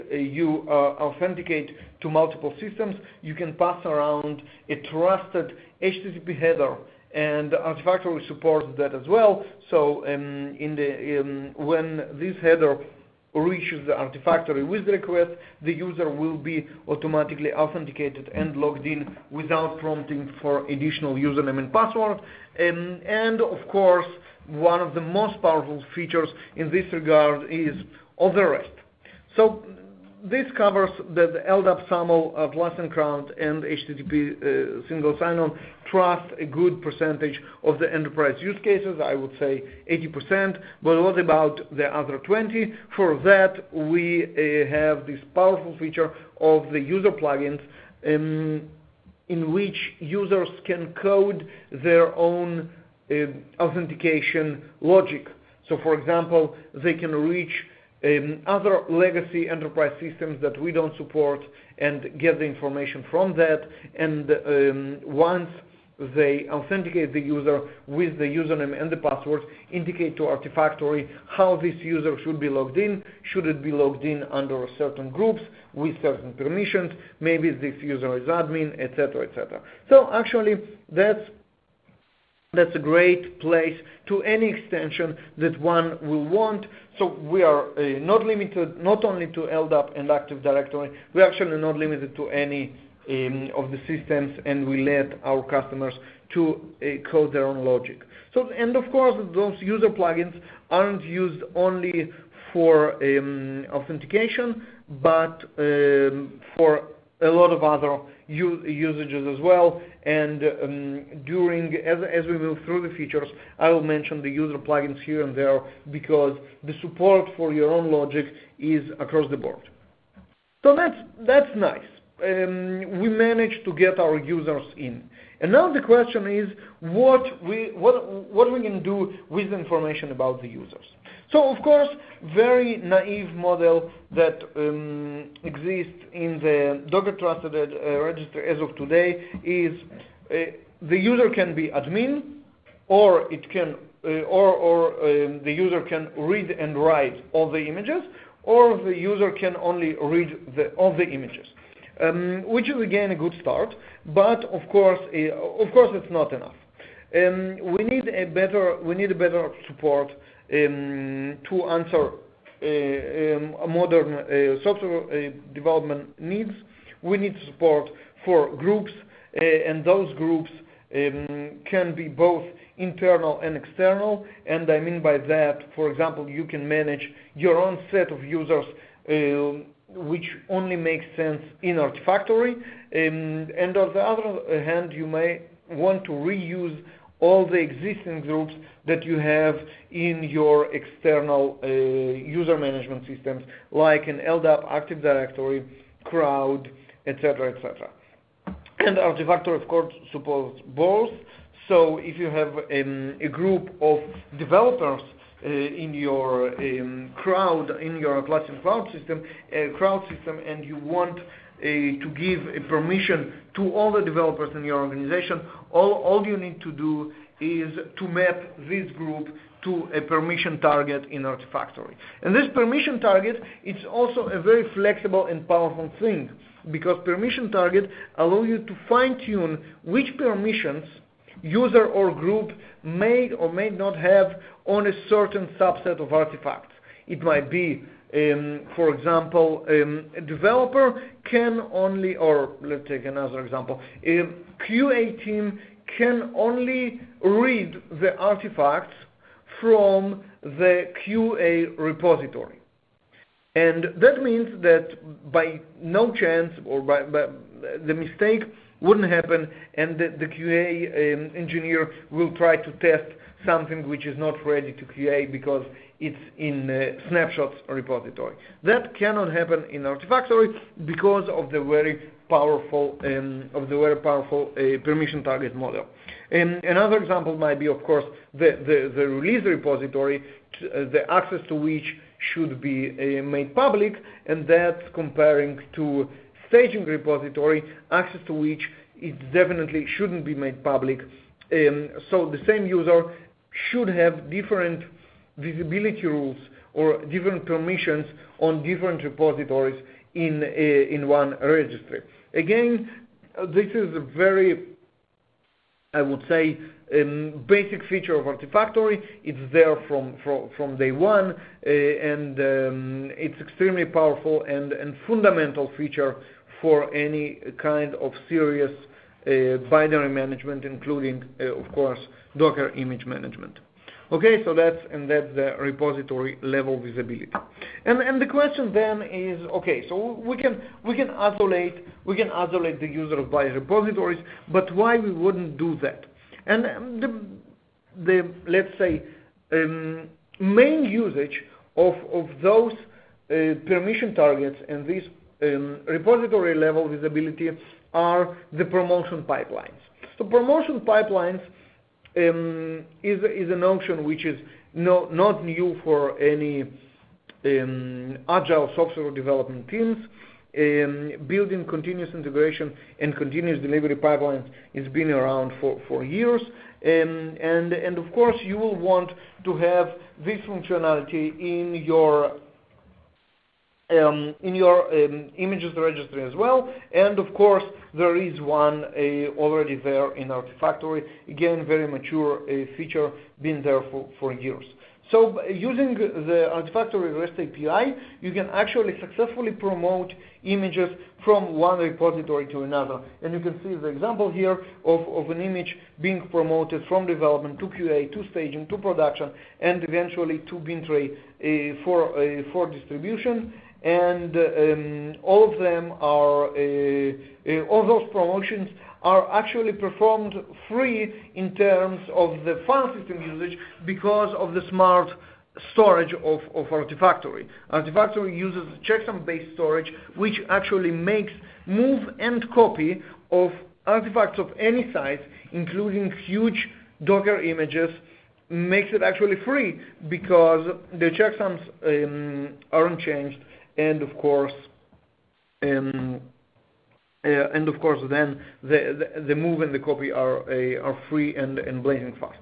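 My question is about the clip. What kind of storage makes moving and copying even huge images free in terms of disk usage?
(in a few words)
checksum-based storage.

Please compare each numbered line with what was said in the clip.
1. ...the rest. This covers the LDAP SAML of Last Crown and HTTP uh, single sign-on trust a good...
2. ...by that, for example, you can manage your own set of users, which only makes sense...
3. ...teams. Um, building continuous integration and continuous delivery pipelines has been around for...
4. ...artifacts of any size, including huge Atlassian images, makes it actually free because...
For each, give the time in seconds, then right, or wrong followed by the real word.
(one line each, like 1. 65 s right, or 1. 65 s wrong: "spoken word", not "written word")
1. 28 s right
2. 174 s right
3. 359 s right
4. 423 s wrong: "Docker", not "Atlassian".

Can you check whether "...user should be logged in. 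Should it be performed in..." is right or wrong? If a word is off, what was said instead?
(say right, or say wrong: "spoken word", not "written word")
wrong: "logged", not "performed".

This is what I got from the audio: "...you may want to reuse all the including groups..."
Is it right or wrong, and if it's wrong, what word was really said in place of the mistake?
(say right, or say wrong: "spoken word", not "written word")
wrong: "existing", not "including".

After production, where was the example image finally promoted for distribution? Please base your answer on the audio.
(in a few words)
Bintray.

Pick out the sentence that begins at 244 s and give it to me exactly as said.
Um, a QA team can only read the artifacts from the QA repository.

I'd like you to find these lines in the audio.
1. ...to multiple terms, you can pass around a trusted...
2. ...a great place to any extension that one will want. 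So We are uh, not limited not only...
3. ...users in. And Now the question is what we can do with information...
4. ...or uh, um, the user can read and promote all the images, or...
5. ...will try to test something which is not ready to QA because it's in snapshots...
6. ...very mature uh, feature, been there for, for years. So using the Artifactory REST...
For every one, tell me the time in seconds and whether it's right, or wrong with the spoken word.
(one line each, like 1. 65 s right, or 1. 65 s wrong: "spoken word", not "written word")
1. 1 s wrong: "systems", not "terms"
2. 82 s right
3. 124 s right
4. 142 s wrong: "write", not "promote"
5. 262 s right
6. 381 s right.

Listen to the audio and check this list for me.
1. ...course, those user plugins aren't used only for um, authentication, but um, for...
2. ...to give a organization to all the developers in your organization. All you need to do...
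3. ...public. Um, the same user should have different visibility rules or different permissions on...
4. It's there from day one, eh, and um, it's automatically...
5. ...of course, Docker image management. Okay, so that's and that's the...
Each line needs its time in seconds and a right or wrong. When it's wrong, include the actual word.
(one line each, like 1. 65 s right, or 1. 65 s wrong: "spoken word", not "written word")
1. 98 s right
2. 211 s wrong: "permission", not "organization"
3. 290 s right
4. 309 s wrong: "extremely", not "automatically"
5. 321 s right.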